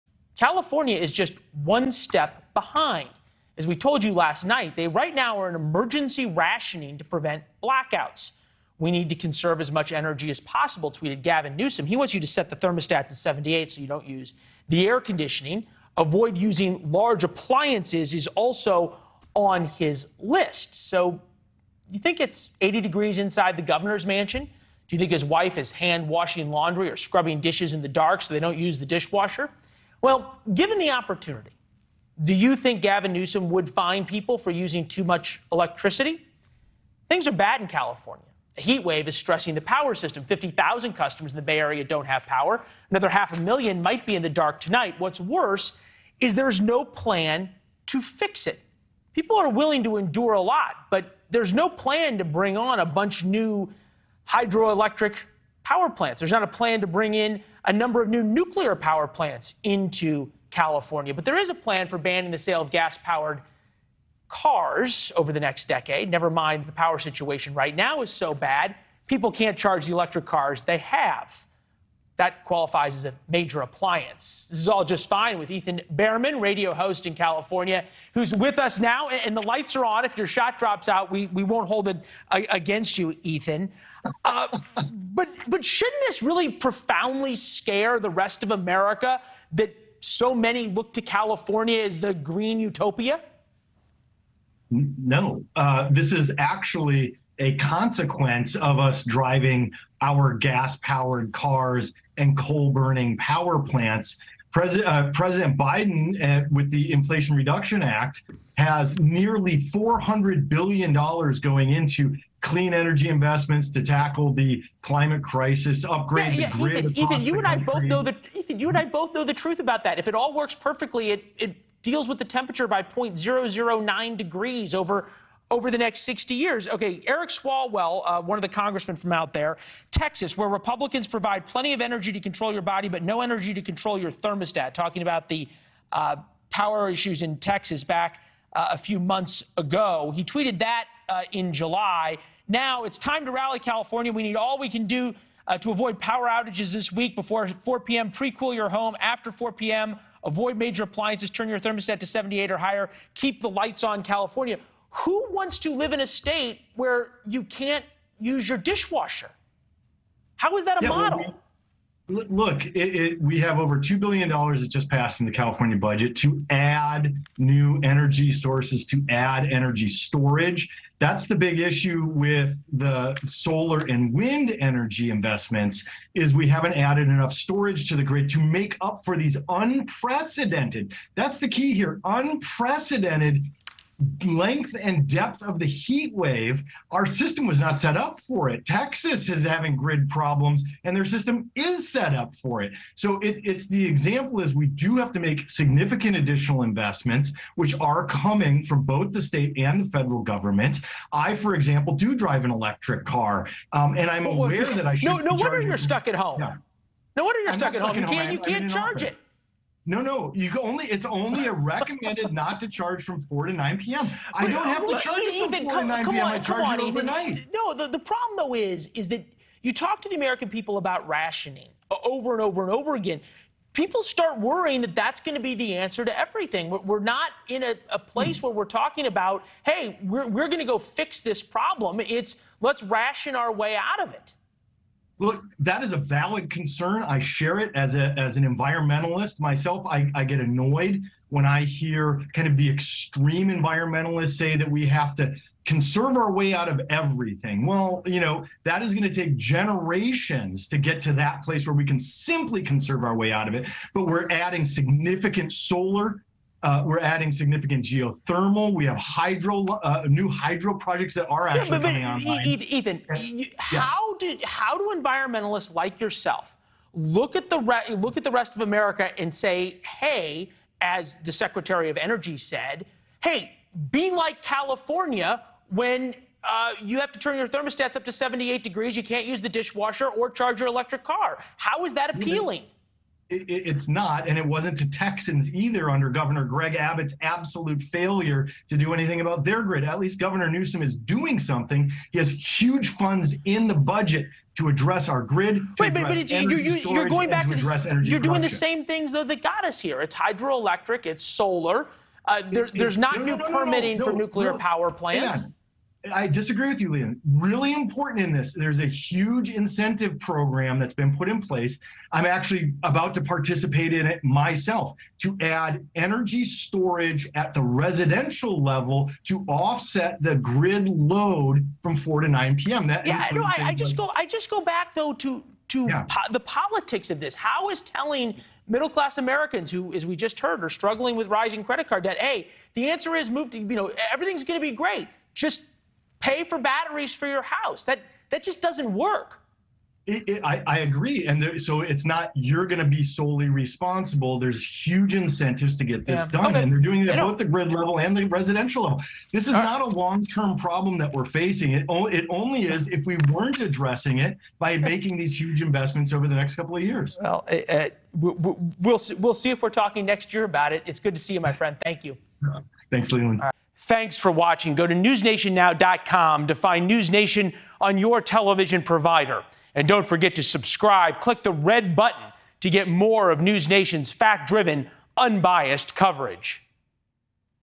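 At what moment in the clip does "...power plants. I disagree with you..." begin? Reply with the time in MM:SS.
05:04.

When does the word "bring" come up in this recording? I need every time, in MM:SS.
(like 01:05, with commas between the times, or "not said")
00:52, 00:56.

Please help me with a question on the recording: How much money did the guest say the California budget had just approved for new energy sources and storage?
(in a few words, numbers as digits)
Over $2 billion.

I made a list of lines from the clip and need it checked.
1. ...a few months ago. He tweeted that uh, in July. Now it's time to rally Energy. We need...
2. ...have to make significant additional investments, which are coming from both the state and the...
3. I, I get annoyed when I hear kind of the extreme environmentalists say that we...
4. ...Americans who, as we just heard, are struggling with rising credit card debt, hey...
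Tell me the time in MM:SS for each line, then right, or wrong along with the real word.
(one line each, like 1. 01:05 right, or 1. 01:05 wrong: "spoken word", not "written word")
1. 02:18 wrong: "California", not "Energy"
2. 03:14 right
3. 03:59 right
4. 05:29 right.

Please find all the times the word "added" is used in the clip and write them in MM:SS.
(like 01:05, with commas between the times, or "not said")
02:56.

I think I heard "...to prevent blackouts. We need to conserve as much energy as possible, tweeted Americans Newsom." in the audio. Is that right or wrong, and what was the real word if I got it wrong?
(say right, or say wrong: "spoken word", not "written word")
wrong: "Gavin", not "Americans".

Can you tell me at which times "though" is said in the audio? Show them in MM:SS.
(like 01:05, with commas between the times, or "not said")
03:38, 04:59, 05:24.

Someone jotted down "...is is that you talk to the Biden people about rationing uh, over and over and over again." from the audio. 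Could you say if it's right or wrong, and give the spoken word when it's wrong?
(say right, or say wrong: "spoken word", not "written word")
wrong: "American", not "Biden".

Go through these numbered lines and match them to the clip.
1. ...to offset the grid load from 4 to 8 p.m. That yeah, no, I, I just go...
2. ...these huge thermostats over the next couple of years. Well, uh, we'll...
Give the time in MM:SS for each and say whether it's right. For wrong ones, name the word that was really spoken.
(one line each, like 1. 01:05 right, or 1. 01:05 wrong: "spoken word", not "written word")
1. 05:19 wrong: "9", not "8"
2. 05:55 wrong: "investments", not "thermostats".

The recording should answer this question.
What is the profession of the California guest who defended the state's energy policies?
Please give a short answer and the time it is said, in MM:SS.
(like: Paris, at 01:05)
Radio host, at 01:16.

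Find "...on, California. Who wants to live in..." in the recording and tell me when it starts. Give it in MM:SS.
02:33.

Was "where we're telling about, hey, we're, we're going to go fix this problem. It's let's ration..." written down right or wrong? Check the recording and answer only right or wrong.
wrong.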